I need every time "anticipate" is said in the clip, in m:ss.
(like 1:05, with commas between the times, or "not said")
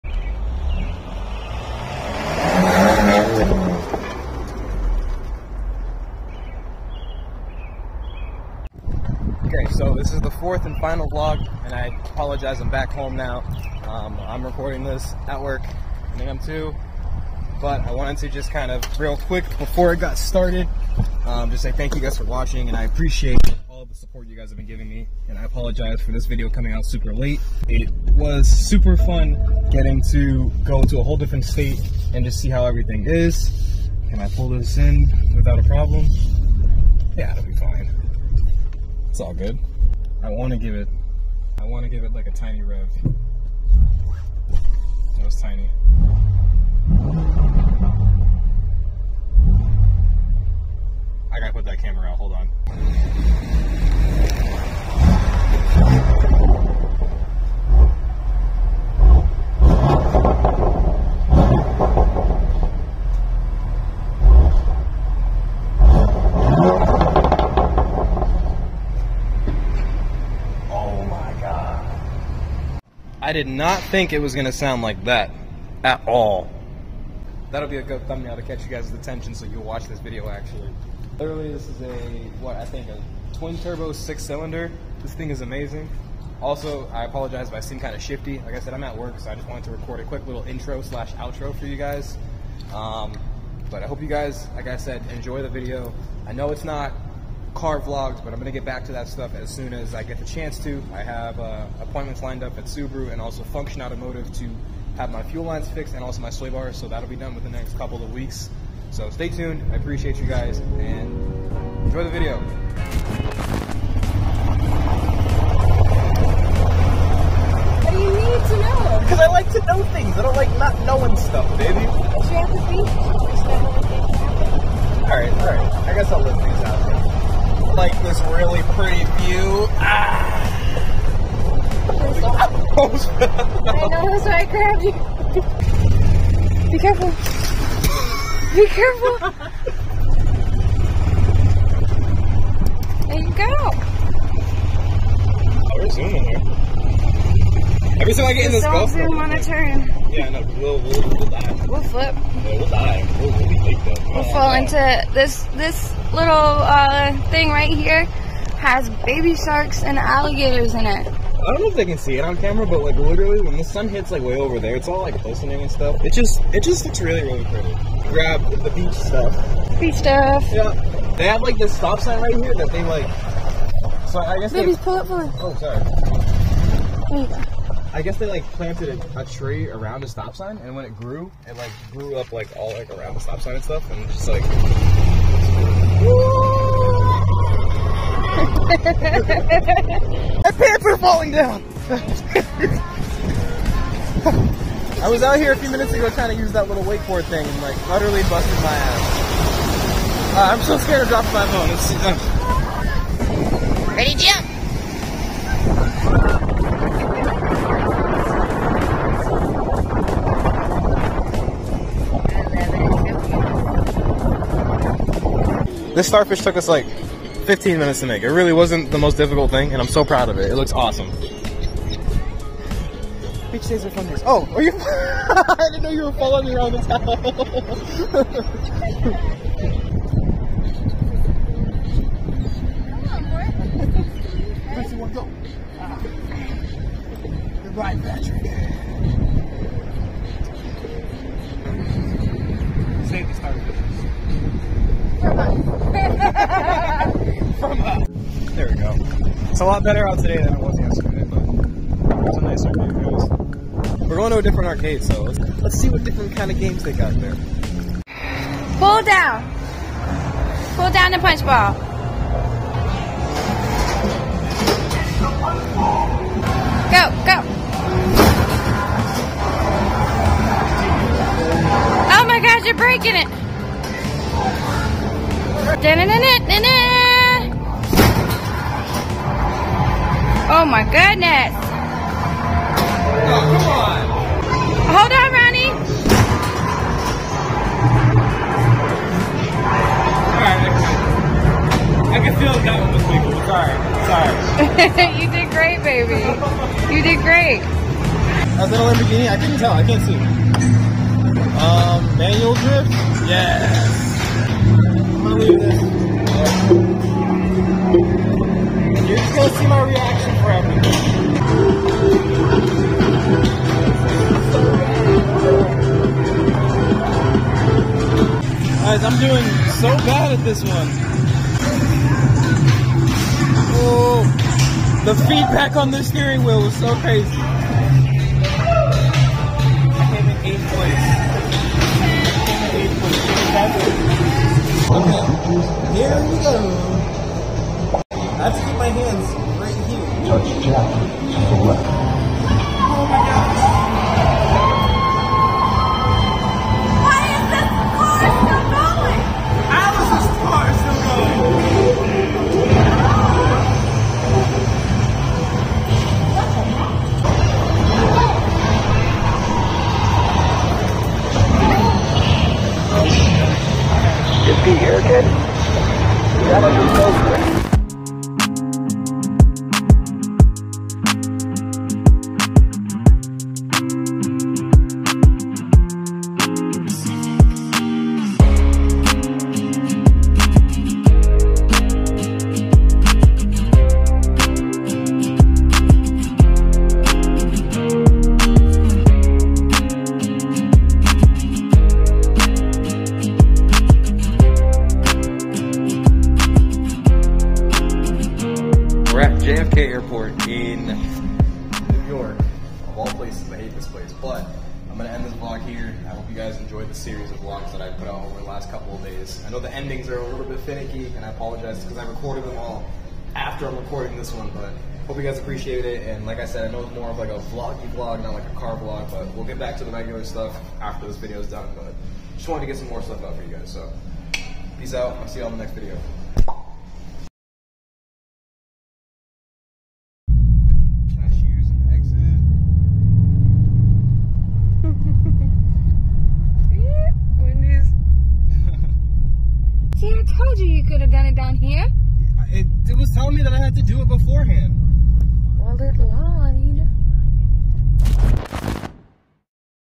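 not said.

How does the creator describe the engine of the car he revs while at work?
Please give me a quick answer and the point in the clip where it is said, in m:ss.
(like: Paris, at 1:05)
twin turbo six cylinder, at 1:23.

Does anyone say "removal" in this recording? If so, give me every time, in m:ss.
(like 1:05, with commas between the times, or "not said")
not said.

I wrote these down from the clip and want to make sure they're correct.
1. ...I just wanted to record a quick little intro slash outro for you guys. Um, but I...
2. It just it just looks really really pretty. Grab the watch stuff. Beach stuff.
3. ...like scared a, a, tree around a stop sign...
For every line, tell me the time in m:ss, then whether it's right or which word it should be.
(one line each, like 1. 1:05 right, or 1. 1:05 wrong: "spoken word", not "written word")
1. 1:29 right
2. 2:46 wrong: "beach", not "watch"
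3. 2:58 wrong: "planted", not "scared".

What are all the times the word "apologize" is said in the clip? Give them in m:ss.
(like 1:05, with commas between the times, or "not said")
0:12, 0:25, 1:27, 6:51.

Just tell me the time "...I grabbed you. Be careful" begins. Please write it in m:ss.
2:14.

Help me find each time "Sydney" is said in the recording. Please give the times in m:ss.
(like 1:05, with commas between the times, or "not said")
not said.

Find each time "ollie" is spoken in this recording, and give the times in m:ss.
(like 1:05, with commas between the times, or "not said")
not said.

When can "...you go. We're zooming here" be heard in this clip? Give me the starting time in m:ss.
2:23.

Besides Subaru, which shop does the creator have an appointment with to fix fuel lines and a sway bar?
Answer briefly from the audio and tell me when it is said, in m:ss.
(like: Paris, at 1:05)
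Function Automotive, at 1:43.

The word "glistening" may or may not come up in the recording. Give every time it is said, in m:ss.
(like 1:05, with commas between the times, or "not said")
2:45.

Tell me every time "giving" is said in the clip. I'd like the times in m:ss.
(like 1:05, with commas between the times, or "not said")
0:24.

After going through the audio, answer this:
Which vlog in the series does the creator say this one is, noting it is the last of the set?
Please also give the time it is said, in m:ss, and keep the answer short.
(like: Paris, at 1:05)
fourth, at 0:10.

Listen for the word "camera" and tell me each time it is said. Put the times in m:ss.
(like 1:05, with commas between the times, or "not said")
0:51, 2:42.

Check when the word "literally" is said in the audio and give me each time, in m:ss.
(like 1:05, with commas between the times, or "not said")
1:21, 2:42.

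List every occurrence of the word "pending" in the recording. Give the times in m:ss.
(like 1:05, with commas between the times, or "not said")
not said.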